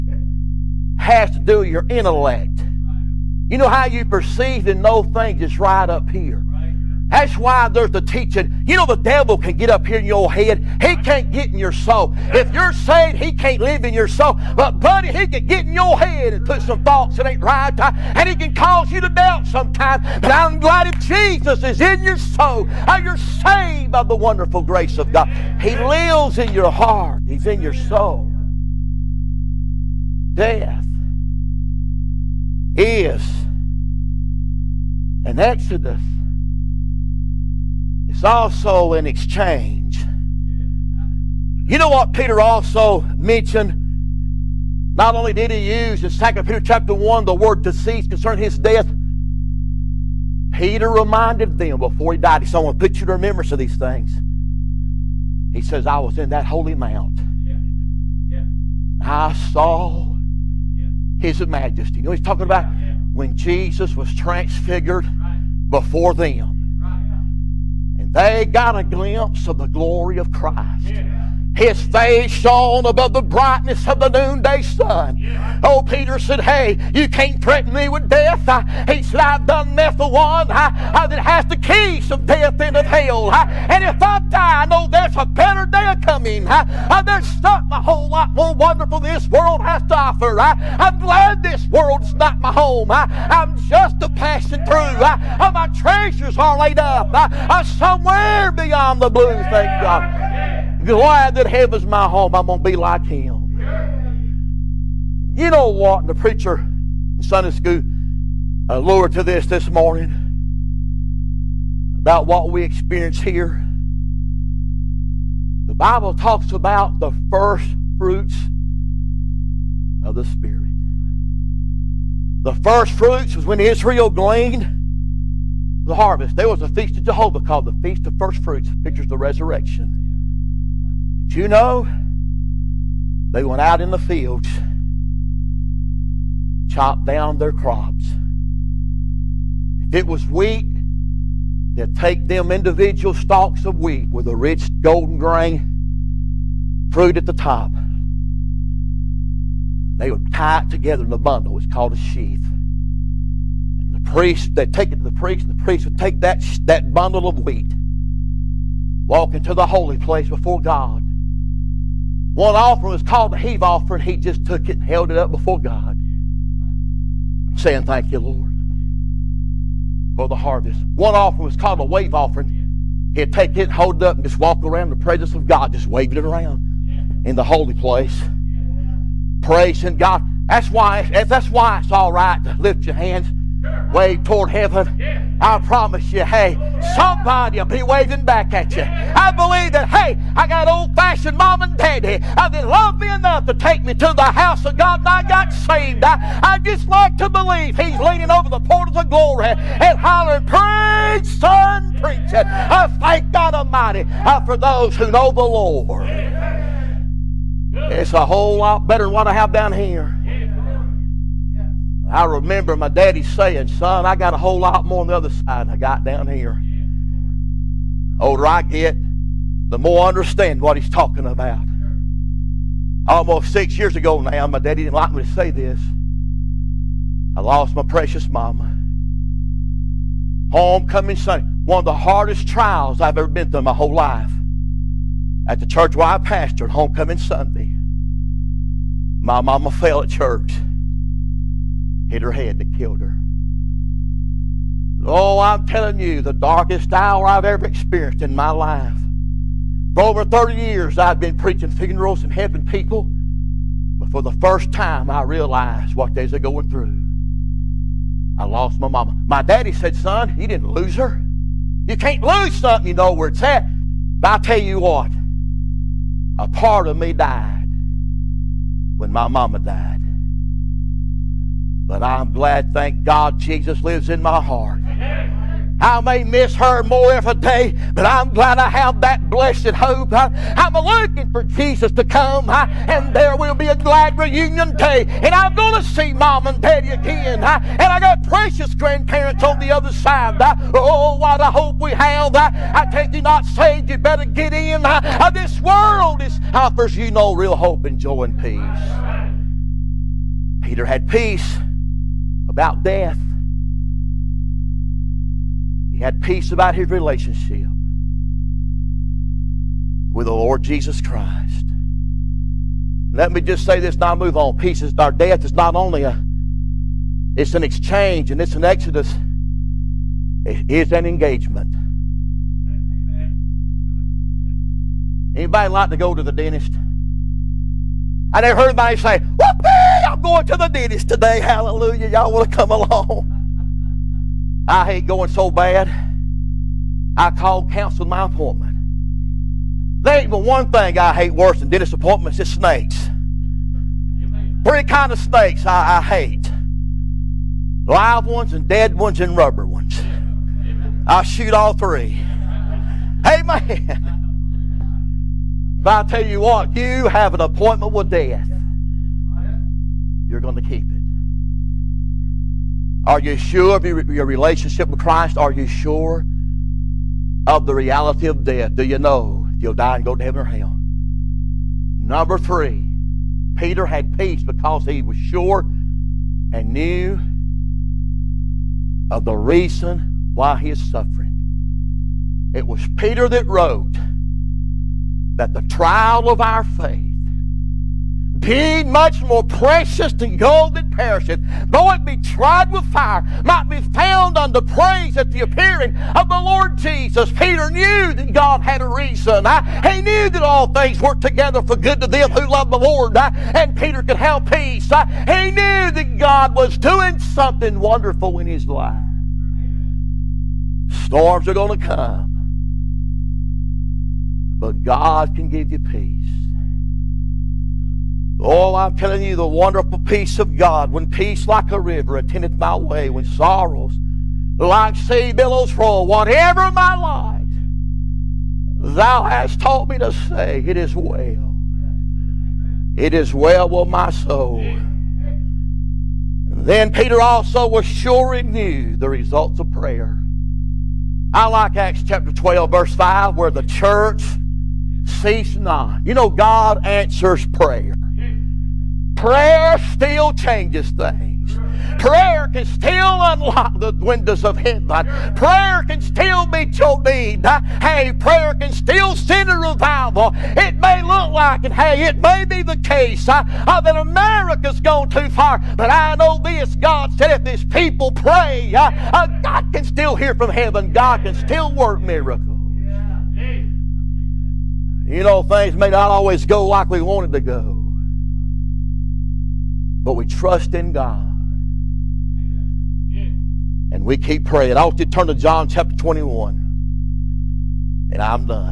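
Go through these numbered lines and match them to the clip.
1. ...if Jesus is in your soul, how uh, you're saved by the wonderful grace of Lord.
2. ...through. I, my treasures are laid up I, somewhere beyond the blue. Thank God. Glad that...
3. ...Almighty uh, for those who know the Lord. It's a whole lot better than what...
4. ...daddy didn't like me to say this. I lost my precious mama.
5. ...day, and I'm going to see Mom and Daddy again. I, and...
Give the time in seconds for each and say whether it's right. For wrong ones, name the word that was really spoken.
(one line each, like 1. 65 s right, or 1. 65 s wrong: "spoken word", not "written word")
1. 20 s wrong: "God", not "Lord"
2. 94 s right
3. 203 s right
4. 224 s right
5. 284 s right.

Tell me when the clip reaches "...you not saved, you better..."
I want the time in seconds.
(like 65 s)
293 s.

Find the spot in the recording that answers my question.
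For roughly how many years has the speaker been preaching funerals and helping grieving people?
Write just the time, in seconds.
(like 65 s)
250 s.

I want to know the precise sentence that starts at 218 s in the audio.
The older I get, the more I understand what he's talking about.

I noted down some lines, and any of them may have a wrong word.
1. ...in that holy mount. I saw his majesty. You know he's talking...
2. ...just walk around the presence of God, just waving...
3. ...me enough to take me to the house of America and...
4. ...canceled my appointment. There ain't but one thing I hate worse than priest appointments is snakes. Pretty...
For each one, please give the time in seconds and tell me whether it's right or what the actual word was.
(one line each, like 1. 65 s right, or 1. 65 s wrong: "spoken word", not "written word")
1. 56 s right
2. 174 s right
3. 193 s wrong: "God", not "America"
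4. 337 s wrong: "dentist", not "priest".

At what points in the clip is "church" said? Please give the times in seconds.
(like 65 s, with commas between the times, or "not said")
235 s, 240 s, 443 s.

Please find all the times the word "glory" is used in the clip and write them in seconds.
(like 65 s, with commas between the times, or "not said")
69 s, 199 s.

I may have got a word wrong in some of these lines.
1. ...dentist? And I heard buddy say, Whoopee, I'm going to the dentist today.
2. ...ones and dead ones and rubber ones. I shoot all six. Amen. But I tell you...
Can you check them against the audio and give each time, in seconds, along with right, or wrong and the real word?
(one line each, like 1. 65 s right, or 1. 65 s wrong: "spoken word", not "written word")
1. 326 s wrong: "anybody", not "buddy"
2. 348 s wrong: "three", not "six".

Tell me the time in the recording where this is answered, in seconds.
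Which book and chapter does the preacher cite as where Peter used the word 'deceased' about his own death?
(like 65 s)
46 s.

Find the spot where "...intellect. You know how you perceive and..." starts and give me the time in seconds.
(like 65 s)
1 s.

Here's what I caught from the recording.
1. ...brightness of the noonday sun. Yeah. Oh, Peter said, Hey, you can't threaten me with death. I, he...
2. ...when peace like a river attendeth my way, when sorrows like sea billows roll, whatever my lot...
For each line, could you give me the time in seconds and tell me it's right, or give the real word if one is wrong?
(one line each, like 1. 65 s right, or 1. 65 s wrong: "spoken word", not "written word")
1. 73 s right
2. 420 s right.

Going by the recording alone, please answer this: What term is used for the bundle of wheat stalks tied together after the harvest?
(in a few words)
sheath.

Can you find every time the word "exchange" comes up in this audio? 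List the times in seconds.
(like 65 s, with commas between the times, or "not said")
39 s, 317 s.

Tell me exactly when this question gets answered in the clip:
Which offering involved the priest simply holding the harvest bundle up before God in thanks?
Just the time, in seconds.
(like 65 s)
163 s.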